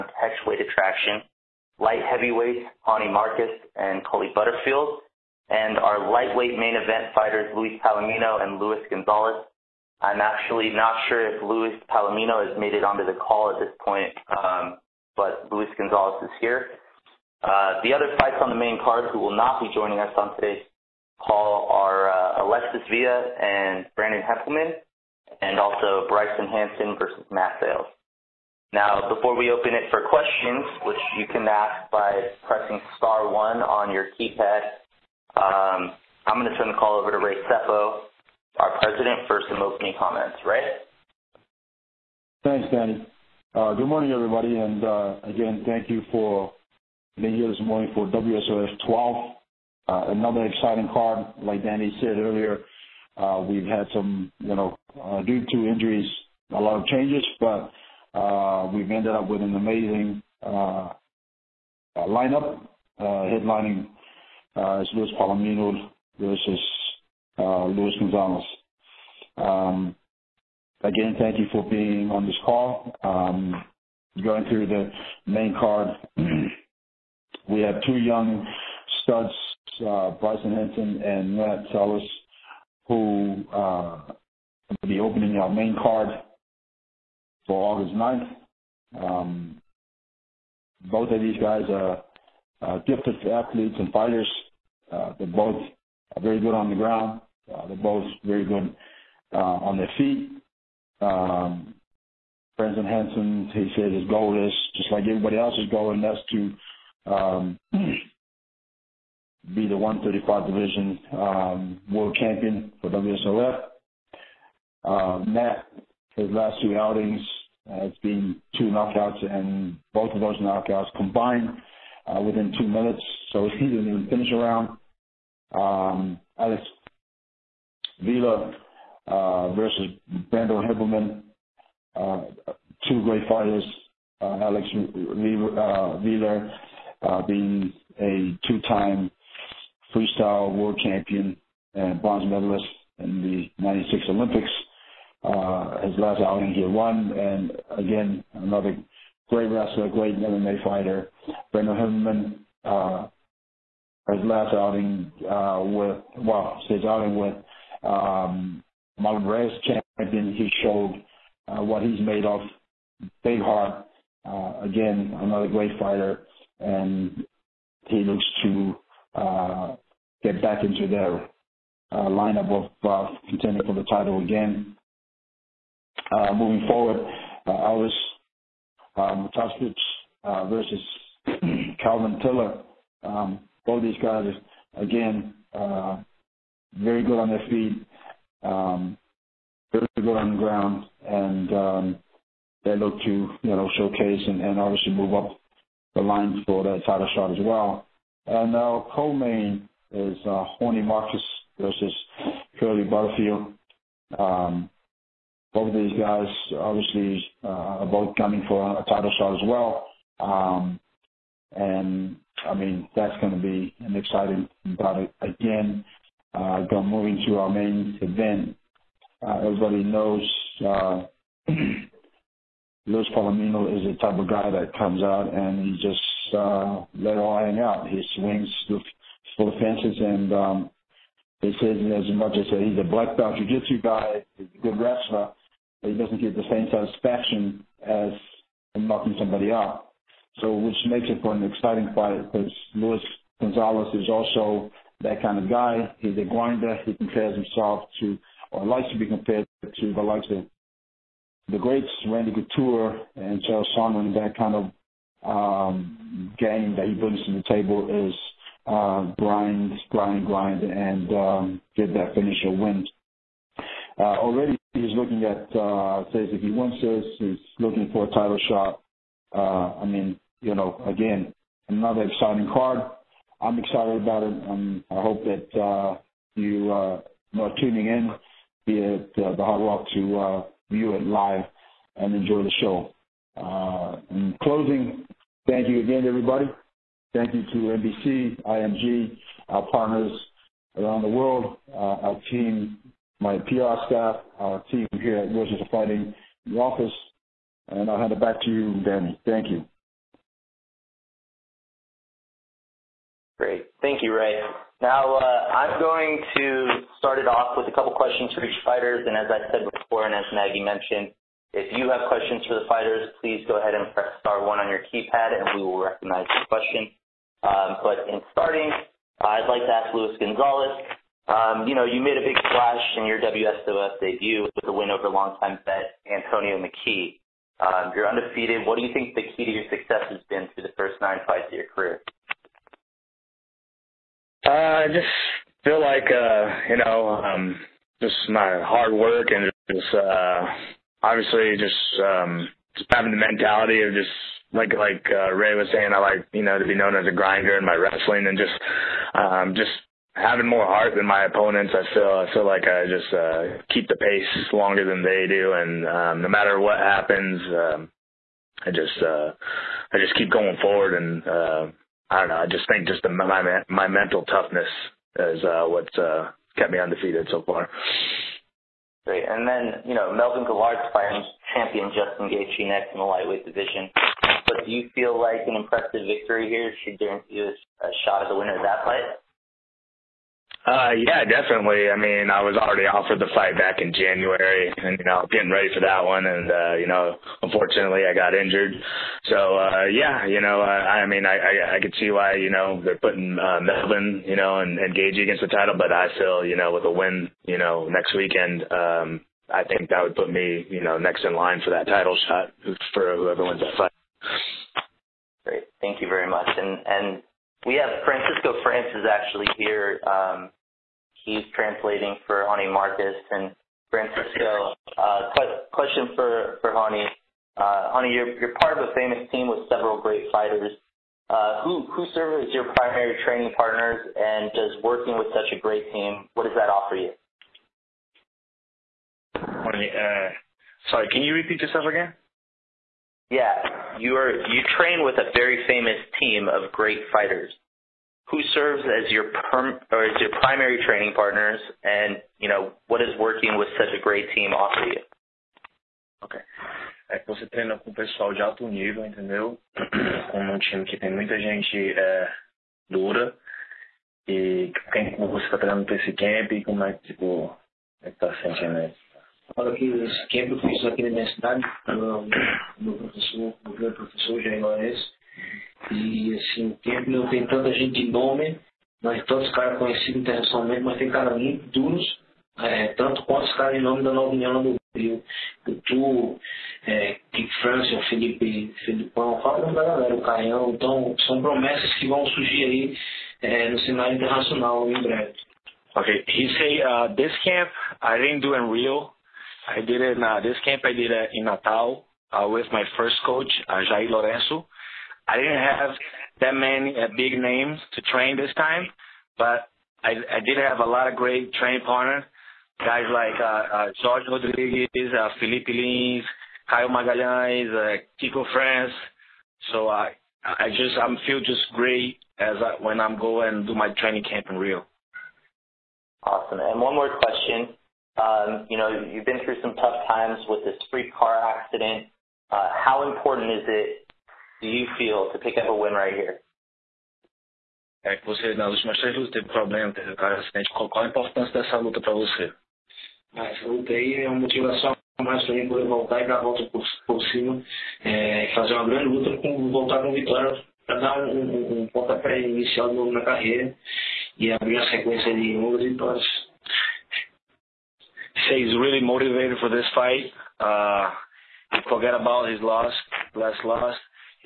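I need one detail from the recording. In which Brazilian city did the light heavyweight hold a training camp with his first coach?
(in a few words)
Natal.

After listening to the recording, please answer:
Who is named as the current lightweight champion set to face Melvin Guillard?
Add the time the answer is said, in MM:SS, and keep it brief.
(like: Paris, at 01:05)
Justin Gaethje, at 06:11.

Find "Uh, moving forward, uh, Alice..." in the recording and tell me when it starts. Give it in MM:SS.
02:56.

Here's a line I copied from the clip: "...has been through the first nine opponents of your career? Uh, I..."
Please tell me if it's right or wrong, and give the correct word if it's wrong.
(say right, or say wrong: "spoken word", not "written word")
wrong: "fights", not "opponents".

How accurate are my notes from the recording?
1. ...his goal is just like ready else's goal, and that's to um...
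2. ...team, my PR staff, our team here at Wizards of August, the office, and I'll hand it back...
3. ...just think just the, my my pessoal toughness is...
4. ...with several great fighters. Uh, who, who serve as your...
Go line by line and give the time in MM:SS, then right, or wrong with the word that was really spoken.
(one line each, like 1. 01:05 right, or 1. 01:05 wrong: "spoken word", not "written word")
1. 01:43 wrong: "everybody", not "ready"
2. 04:52 wrong: "Fighting", not "August"
3. 06:02 wrong: "mental", not "pessoal"
4. 06:59 right.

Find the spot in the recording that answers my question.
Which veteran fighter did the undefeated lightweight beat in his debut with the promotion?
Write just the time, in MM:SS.
05:26.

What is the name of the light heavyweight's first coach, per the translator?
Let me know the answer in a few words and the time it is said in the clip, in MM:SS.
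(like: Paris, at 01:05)
Jair Lorenzo, at 08:13.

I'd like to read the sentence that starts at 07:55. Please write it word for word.
O Tu, é, Kick France, o Felipe, Felipão, fala da galera, o Caião.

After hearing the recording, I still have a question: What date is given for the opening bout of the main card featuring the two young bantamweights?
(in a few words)
August 9.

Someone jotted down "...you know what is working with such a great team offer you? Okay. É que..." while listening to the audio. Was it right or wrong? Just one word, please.
right.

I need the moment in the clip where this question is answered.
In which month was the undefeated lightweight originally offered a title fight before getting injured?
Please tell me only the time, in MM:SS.
06:23.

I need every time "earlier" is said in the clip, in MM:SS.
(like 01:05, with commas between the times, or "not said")
00:52.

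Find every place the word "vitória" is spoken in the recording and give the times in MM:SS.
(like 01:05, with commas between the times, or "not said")
09:00, 09:05.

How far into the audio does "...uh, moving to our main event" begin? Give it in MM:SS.
03:36.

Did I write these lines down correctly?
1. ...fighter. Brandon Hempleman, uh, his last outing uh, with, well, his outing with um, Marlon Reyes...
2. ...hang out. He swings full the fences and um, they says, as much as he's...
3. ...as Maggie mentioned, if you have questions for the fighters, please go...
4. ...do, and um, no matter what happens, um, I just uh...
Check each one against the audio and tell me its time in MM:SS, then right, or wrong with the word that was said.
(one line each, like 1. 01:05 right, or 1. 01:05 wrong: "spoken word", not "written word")
1. 02:30 right
2. 03:47 right
3. 05:10 right
4. 05:55 right.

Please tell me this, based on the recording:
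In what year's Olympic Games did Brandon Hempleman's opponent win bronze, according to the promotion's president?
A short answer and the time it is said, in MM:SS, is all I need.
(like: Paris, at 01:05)
1996, at 02:23.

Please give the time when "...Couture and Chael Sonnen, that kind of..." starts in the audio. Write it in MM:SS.
04:12.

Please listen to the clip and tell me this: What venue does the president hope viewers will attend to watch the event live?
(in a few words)
the Hard Rock.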